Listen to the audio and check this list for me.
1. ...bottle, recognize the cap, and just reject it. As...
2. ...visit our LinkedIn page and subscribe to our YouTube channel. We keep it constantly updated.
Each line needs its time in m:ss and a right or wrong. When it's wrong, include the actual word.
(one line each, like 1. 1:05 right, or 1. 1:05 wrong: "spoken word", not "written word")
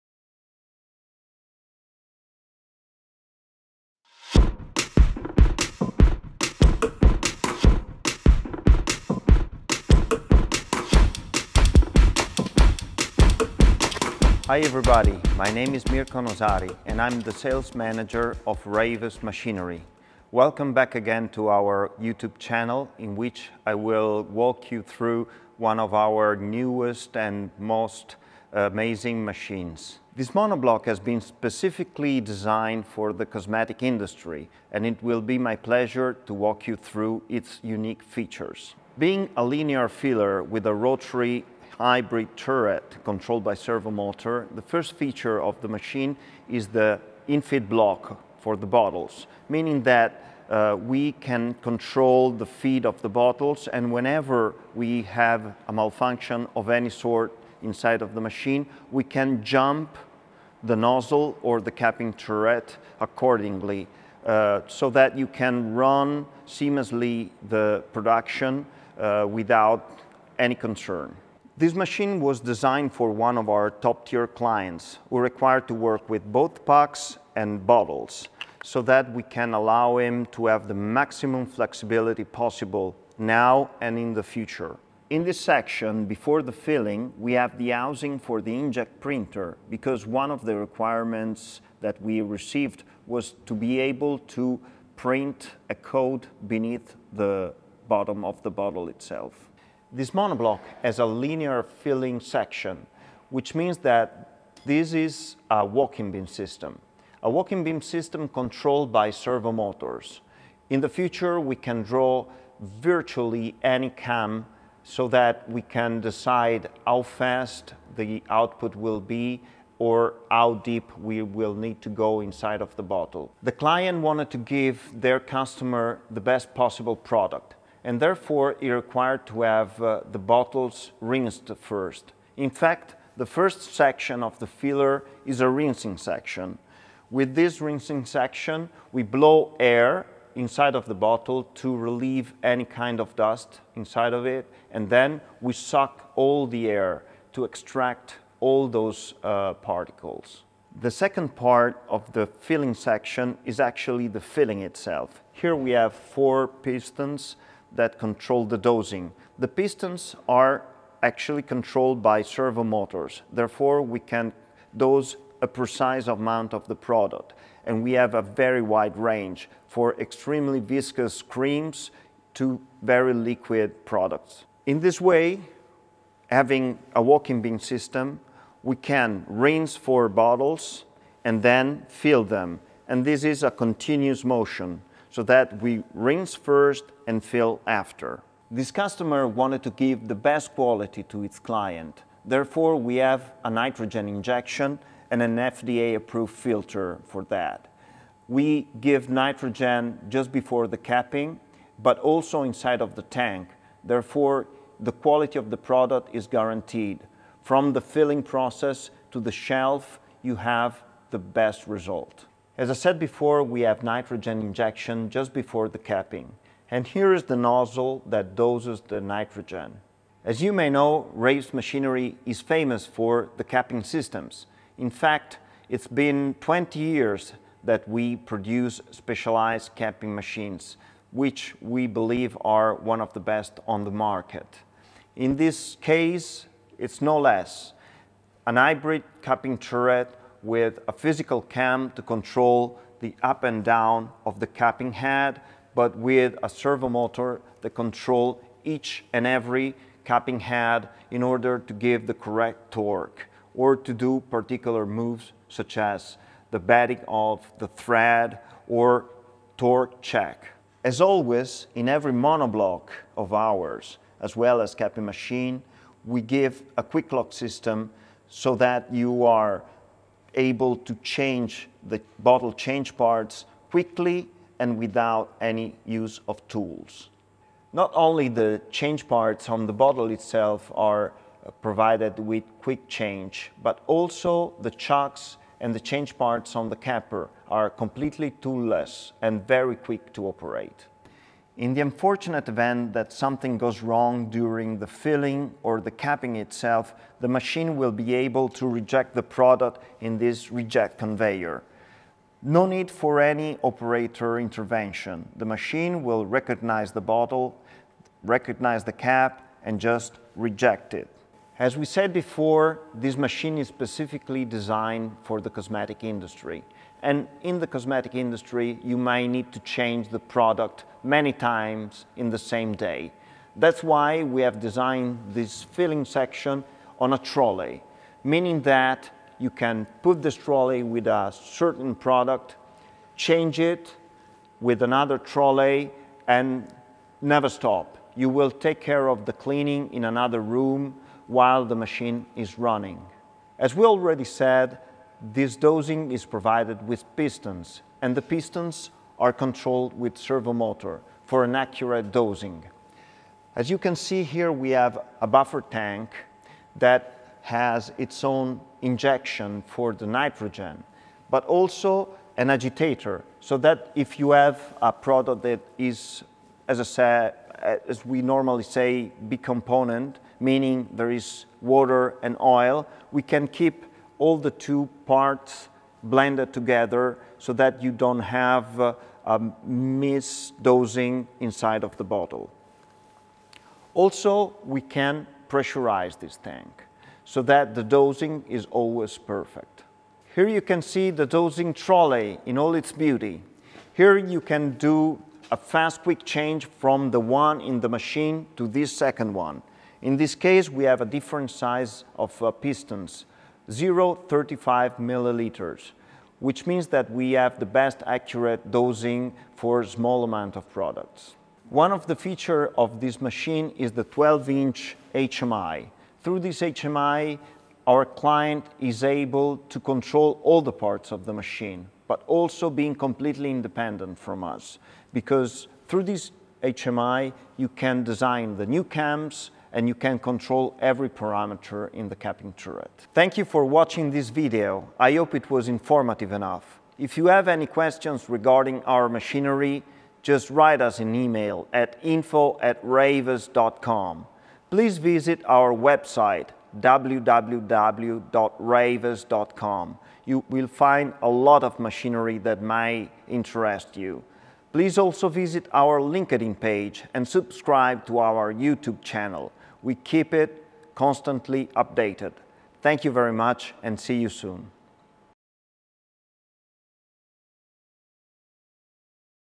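1. 5:07 right
2. 7:35 right.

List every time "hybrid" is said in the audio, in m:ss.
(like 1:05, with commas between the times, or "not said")
0:41, 3:58.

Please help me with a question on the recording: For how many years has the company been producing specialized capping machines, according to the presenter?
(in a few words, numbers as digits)
20.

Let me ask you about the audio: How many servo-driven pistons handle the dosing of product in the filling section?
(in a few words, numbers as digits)
4.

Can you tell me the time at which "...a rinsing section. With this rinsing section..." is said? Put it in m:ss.
2:15.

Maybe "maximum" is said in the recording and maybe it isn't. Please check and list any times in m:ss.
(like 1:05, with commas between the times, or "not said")
1:20.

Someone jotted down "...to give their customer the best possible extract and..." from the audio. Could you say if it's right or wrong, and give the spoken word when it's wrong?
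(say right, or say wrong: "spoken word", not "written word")
wrong: "product", not "extract".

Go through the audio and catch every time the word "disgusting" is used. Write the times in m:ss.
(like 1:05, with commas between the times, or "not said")
not said.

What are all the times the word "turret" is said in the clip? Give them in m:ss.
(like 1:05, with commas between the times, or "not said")
0:42, 1:02, 3:59, 7:12.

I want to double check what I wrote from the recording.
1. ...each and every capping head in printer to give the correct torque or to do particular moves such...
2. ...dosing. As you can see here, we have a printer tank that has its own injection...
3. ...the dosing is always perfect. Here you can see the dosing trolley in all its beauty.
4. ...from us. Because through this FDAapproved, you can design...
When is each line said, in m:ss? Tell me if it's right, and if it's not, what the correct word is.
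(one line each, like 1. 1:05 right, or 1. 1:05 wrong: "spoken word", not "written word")
1. 4:08 wrong: "order", not "printer"
2. 5:52 wrong: "buffer", not "printer"
3. 6:27 right
4. 7:04 wrong: "HMI", not "FDAapproved".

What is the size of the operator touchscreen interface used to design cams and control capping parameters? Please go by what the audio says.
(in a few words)
12 inches.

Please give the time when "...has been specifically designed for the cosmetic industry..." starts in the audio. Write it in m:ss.
0:30.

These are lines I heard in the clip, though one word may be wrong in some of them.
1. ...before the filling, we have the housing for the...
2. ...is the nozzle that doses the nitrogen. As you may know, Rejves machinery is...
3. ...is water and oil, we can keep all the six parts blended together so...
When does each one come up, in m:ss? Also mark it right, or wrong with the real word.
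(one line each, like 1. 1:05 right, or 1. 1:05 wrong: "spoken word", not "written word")
1. 1:26 right
2. 3:37 right
3. 6:11 wrong: "two", not "six".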